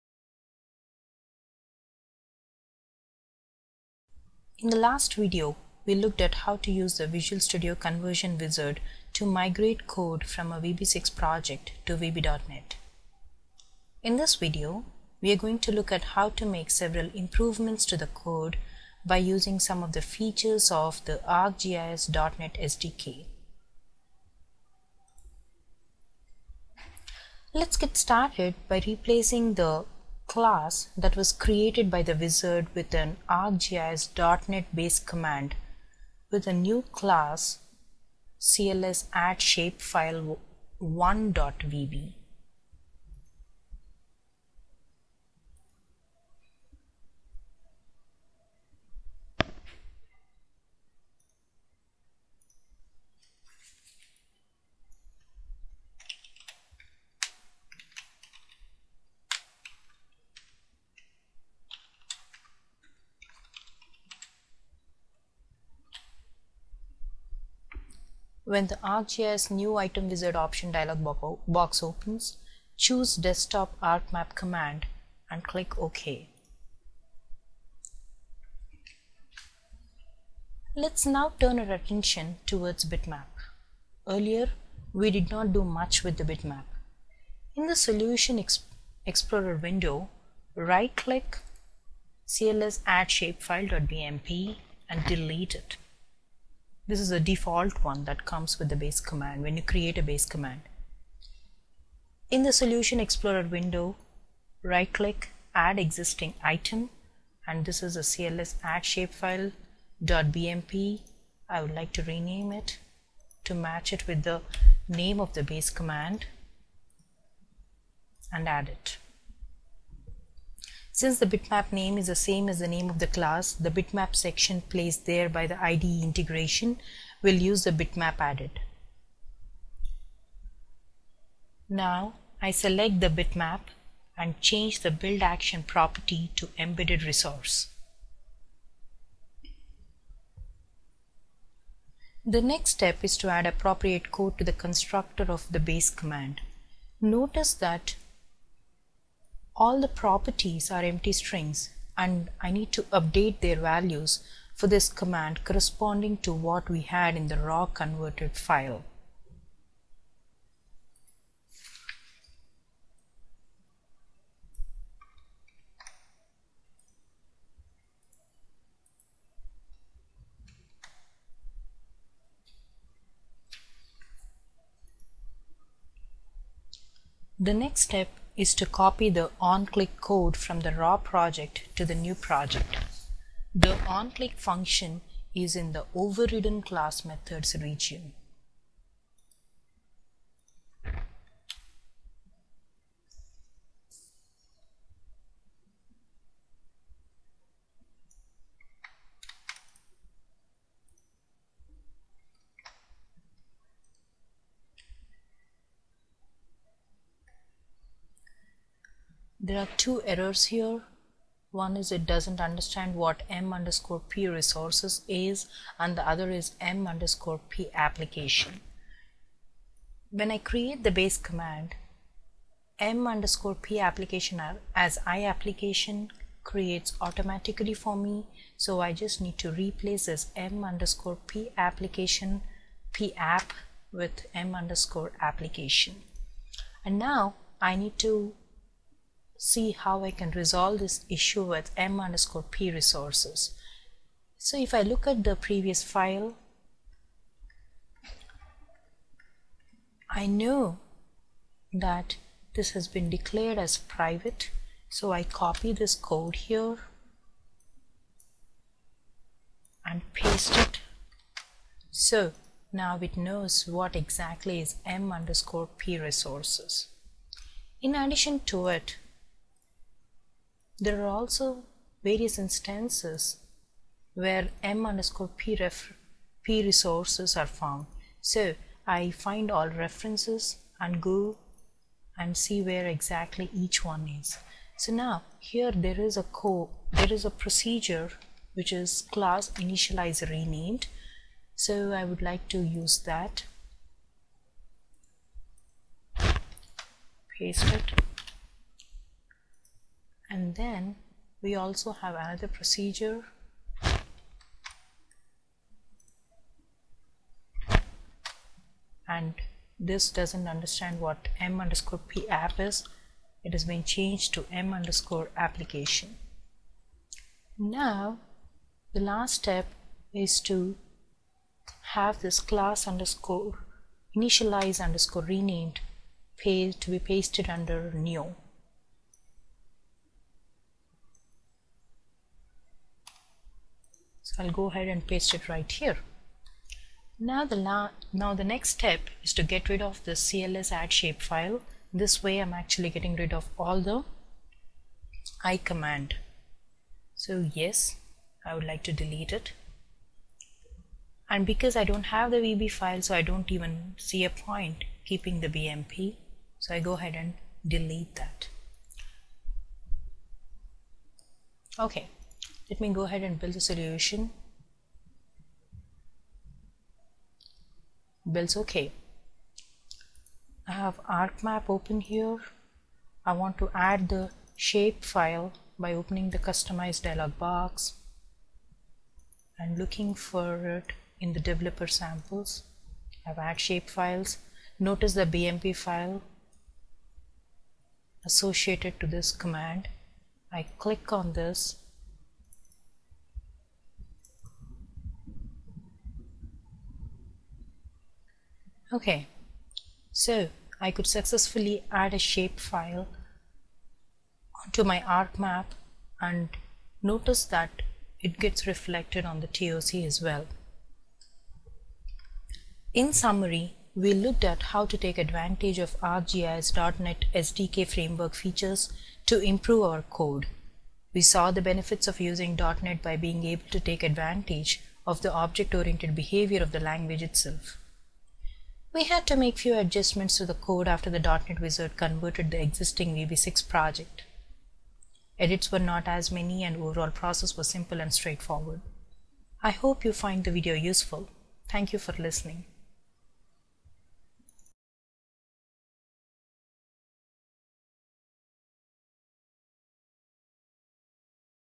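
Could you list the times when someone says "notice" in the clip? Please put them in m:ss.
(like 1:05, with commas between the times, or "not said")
2:27, 6:24, 6:47.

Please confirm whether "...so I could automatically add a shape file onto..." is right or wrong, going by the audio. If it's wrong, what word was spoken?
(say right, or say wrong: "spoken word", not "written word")
wrong: "successfully", not "automatically".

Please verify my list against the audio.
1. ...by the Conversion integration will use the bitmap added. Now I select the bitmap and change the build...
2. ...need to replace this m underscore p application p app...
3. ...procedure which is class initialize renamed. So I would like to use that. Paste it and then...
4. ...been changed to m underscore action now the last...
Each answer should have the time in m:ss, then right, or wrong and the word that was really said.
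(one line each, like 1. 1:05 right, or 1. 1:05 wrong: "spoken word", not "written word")
1. 2:05 wrong: "IDE", not "Conversion"
2. 3:49 right
3. 4:47 right
4. 5:13 wrong: "application", not "action".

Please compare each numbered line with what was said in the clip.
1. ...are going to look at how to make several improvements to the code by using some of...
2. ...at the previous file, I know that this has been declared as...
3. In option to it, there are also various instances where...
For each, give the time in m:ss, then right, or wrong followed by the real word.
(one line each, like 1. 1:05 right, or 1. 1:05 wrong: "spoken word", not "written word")
1. 0:15 right
2. 4:05 right
3. 4:27 wrong: "addition", not "option".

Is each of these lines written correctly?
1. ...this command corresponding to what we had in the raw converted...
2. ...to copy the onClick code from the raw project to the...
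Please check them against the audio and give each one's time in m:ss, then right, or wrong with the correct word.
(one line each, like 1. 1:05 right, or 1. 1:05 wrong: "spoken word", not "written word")
1. 2:34 right
2. 2:58 right.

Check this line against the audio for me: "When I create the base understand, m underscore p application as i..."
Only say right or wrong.
wrong.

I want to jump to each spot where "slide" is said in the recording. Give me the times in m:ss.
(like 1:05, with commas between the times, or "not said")
not said.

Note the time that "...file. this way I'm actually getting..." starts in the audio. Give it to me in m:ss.
5:41.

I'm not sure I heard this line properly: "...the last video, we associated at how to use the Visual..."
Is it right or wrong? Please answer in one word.
wrong.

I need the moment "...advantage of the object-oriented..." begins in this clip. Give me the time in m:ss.
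7:04.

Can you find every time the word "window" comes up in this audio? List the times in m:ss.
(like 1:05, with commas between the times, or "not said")
1:29, 1:43.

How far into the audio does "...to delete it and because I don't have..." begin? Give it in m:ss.
5:48.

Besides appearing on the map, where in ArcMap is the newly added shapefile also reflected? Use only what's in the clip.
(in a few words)
TOC.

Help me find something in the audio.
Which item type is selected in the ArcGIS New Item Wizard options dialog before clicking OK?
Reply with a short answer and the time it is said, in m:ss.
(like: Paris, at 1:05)
Desktop ArcMap command, at 1:13.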